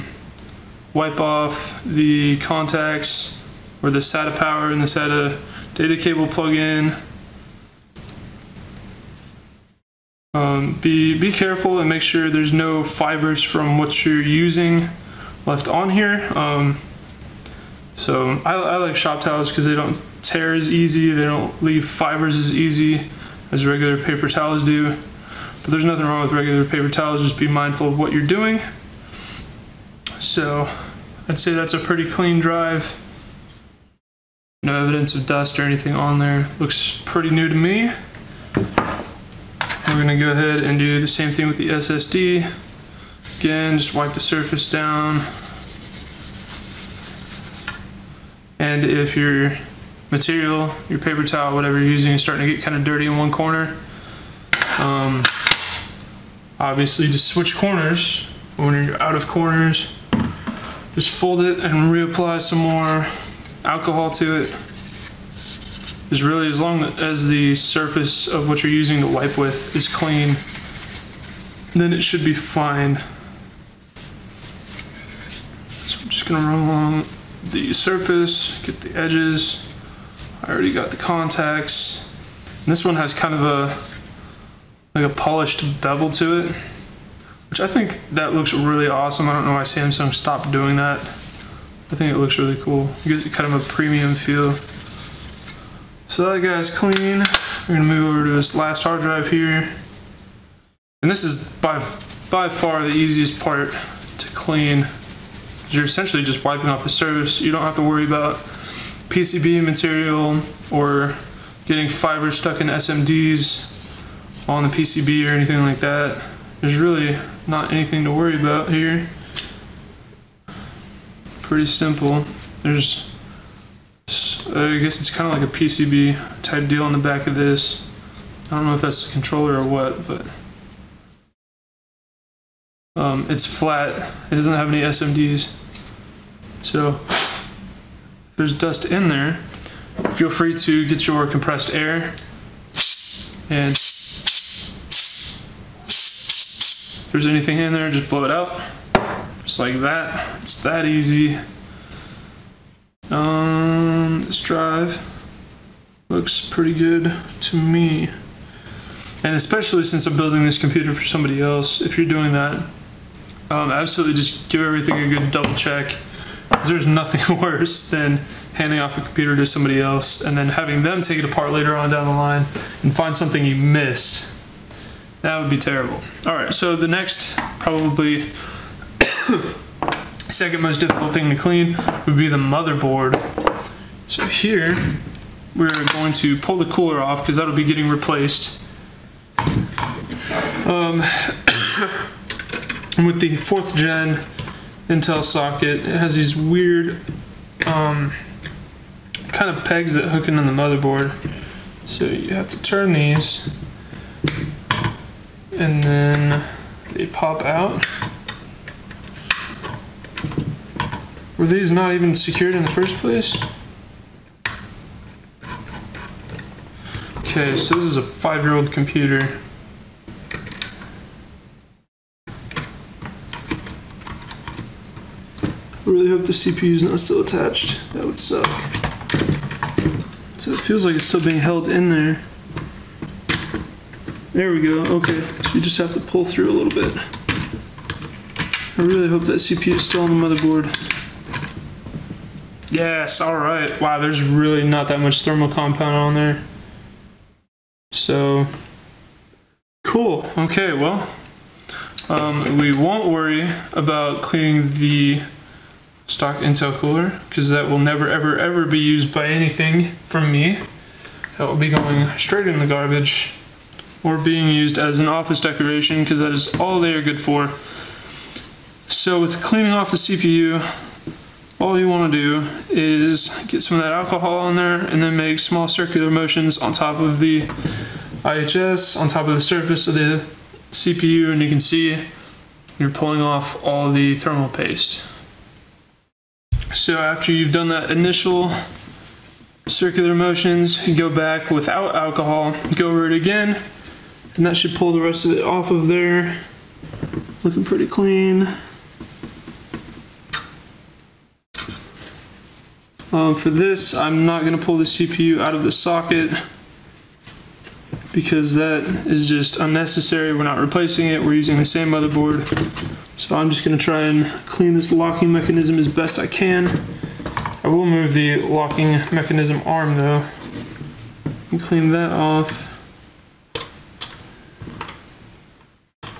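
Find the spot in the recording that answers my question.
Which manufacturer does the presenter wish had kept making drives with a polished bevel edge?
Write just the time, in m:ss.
1:29.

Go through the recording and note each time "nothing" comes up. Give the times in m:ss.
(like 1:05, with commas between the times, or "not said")
0:25, 2:46.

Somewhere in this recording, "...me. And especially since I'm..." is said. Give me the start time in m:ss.
2:37.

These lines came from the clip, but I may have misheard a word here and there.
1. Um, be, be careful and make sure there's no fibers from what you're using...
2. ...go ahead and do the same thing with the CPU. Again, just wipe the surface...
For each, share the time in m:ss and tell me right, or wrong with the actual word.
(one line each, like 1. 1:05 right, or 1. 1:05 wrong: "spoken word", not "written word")
1. 0:10 right
2. 0:40 wrong: "SSD", not "CPU".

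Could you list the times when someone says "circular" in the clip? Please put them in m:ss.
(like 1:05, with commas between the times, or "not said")
4:35, 4:49.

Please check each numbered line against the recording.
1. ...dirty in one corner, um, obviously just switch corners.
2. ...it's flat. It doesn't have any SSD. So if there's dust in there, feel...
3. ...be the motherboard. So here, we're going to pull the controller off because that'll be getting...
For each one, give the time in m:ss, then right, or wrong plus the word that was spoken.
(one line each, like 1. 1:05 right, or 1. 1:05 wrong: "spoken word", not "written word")
1. 0:52 right
2. 2:13 wrong: "SMDs", not "SSD"
3. 3:02 wrong: "cooler", not "controller".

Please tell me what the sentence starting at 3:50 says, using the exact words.
So it feels like it's still being held in there.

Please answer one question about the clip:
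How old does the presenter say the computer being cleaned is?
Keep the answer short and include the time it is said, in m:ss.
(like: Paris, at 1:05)
5 years, at 3:38.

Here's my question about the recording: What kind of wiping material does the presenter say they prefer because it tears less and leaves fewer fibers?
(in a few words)
Shop towels.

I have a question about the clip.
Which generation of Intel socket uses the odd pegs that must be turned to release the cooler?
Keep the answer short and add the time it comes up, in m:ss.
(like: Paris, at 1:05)
Fourth gen, at 3:13.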